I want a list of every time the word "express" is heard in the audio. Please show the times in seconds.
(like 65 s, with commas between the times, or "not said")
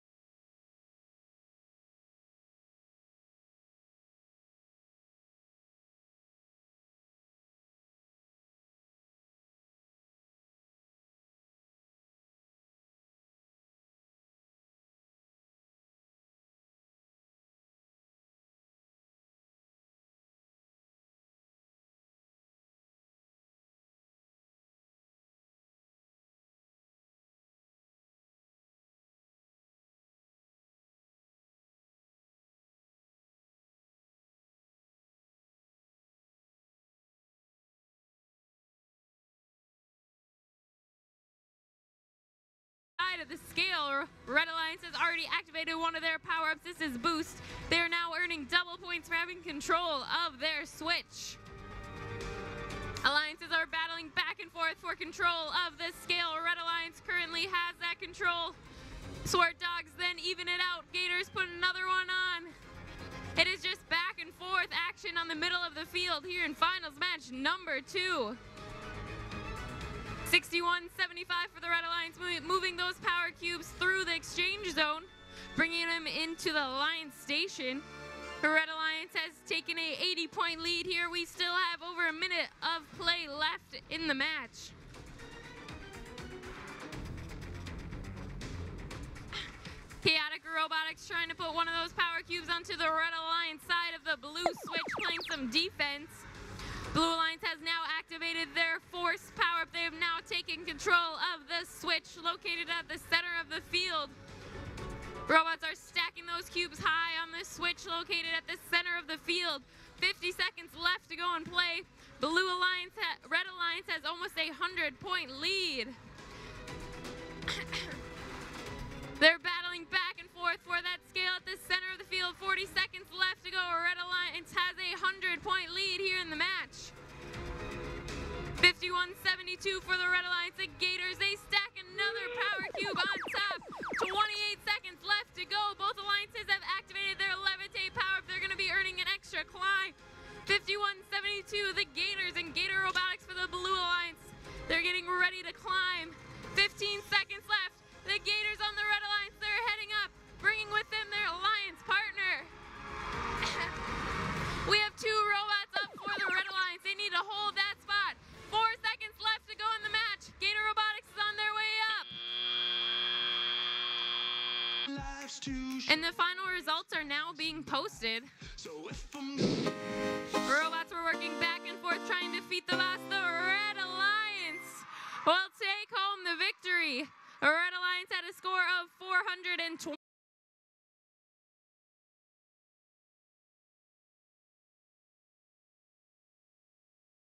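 not said.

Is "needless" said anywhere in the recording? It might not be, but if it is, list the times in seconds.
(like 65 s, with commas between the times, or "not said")
not said.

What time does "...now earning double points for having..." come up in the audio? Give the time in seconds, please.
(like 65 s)
47 s.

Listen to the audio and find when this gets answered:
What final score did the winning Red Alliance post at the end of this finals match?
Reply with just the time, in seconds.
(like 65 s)
178 s.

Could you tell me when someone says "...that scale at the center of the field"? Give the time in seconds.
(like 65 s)
120 s.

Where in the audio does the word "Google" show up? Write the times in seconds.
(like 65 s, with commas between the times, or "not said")
not said.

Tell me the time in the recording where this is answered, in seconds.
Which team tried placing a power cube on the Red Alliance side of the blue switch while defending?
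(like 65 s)
90 s.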